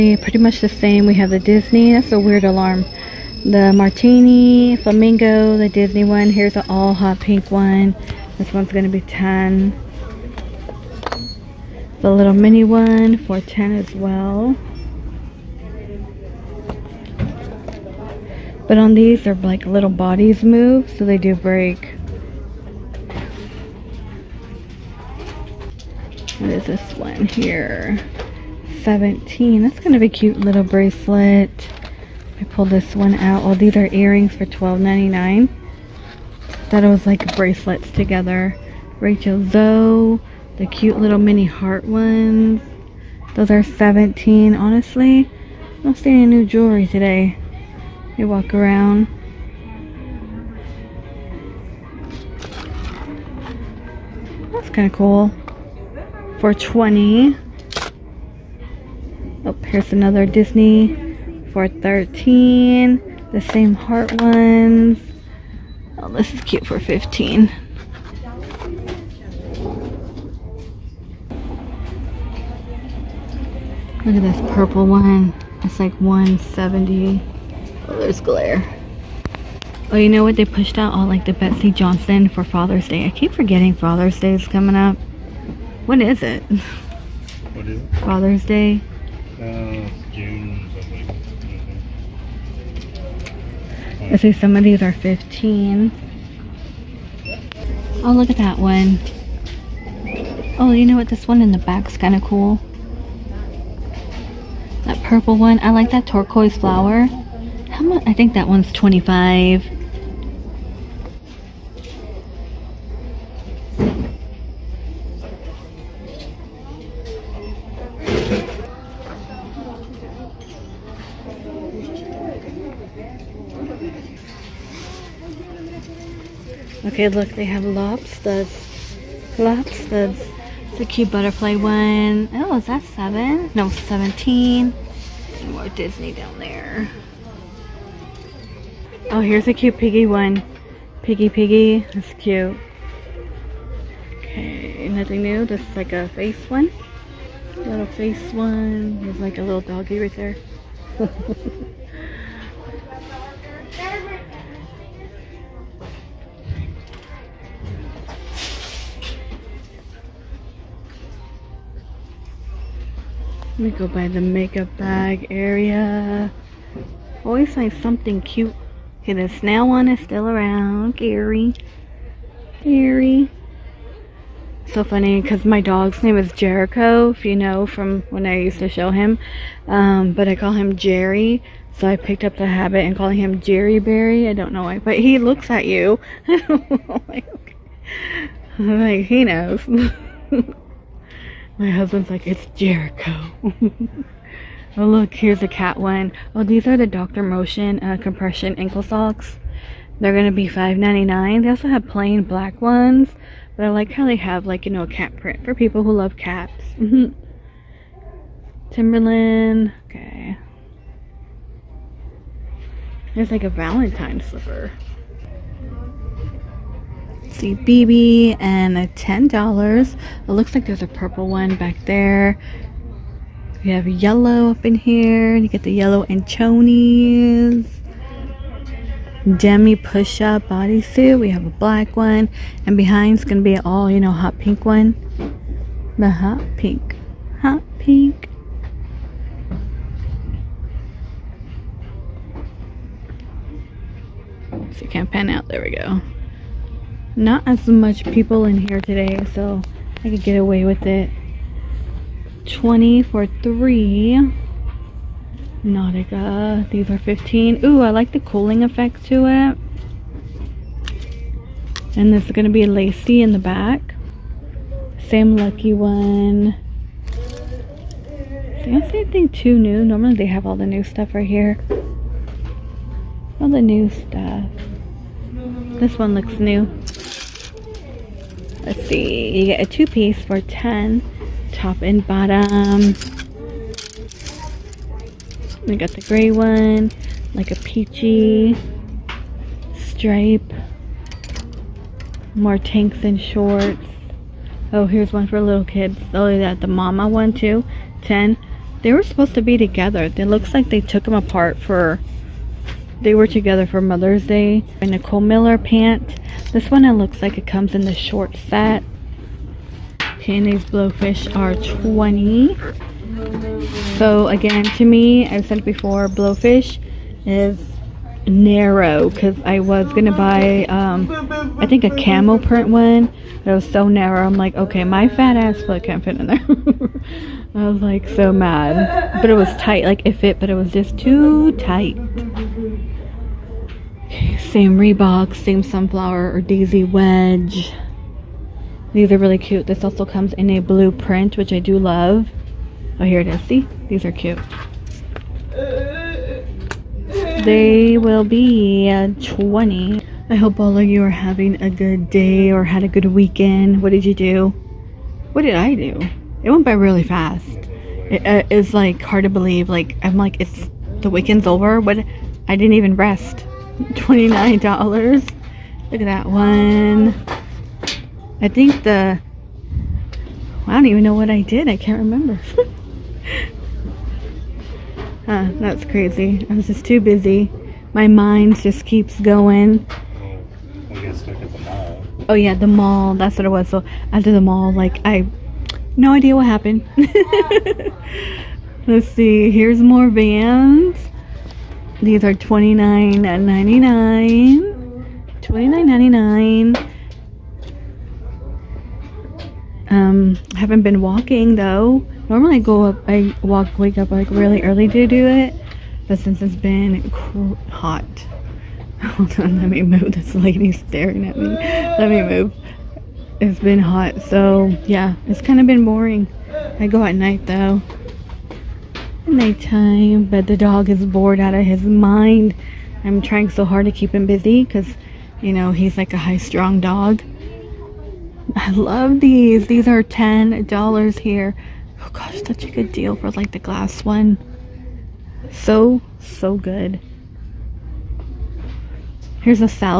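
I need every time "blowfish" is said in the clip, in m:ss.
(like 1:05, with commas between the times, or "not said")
5:10, 5:16.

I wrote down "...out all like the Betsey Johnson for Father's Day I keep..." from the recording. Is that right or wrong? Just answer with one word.
right.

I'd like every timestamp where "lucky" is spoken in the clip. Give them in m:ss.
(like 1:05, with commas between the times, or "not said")
4:25.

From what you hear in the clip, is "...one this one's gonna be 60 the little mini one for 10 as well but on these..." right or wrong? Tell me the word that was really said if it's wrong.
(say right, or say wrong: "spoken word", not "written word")
wrong: "10", not "60".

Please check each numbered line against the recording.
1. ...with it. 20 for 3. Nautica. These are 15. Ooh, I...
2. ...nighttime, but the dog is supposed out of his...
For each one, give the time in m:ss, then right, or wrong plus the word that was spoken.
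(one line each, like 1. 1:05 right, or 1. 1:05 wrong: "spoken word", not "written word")
1. 4:10 right
2. 6:59 wrong: "bored", not "supposed".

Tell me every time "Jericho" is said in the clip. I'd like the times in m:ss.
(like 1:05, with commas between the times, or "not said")
2:56, 3:12.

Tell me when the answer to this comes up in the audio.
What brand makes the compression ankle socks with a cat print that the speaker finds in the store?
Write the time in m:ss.
3:16.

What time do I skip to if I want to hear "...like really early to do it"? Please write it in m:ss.
6:44.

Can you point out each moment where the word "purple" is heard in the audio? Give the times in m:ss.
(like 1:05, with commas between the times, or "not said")
1:14, 1:45, 3:40.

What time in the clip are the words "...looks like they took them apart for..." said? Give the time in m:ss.
5:00.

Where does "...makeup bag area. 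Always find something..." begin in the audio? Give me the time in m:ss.
2:44.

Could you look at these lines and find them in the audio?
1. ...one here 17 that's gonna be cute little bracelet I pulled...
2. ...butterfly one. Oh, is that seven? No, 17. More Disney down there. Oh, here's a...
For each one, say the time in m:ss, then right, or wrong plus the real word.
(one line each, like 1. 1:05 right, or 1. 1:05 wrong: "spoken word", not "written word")
1. 0:26 right
2. 2:11 right.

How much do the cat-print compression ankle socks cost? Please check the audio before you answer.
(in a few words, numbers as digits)
$5.99.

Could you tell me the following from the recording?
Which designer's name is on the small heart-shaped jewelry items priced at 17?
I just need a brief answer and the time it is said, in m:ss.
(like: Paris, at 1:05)
Rachel Zoe, at 0:38.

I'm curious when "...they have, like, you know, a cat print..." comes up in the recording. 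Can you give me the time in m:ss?
3:24.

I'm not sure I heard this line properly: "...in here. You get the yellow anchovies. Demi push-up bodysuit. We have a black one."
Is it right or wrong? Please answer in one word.
right.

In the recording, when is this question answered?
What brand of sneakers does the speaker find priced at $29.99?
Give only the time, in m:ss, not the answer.
6:30.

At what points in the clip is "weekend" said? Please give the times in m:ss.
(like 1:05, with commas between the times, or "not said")
5:53, 6:01.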